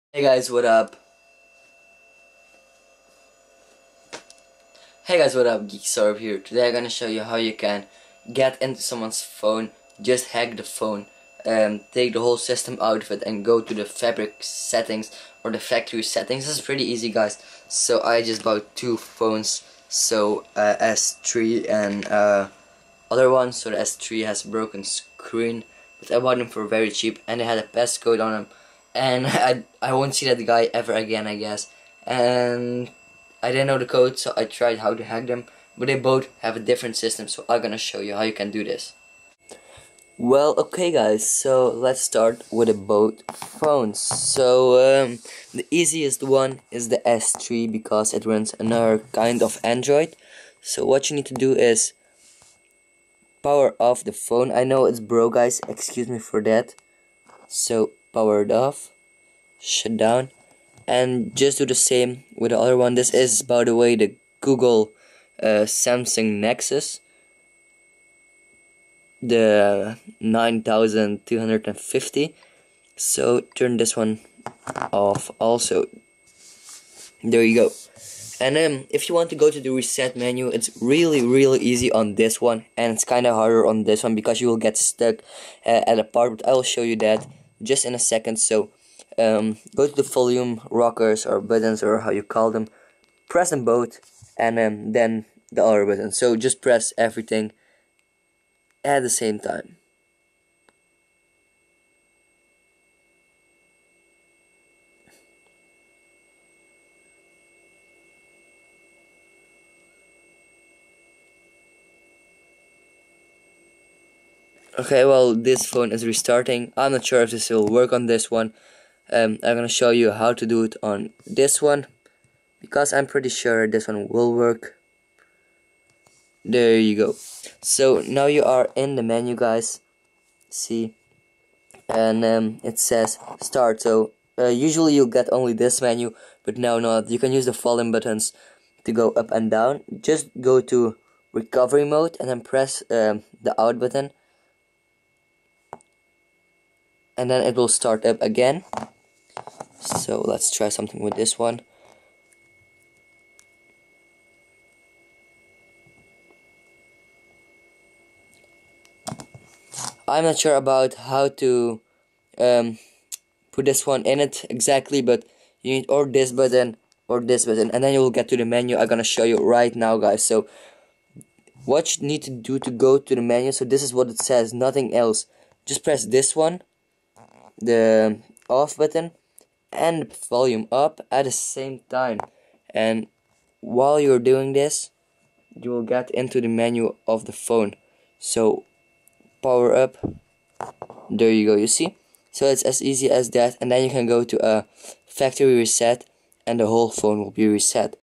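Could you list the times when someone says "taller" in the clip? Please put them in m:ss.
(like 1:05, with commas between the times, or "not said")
not said.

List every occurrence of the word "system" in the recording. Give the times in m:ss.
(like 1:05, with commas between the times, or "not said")
0:12, 0:36.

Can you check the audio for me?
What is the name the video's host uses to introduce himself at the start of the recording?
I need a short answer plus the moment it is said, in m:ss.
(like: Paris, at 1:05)
Geeky Sohrab, at 0:05.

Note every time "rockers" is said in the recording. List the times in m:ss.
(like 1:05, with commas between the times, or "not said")
1:30.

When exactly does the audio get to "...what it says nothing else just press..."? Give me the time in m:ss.
2:53.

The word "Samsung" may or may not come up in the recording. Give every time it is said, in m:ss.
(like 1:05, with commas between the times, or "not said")
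1:05.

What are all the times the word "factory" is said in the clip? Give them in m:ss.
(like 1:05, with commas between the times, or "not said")
0:15, 3:15.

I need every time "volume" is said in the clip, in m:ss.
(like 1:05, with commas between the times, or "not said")
1:30, 2:17, 3:00.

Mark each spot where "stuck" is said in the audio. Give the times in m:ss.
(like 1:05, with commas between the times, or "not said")
1:24.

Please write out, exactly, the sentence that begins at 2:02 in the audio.
Because I'm pretty sure this one will work.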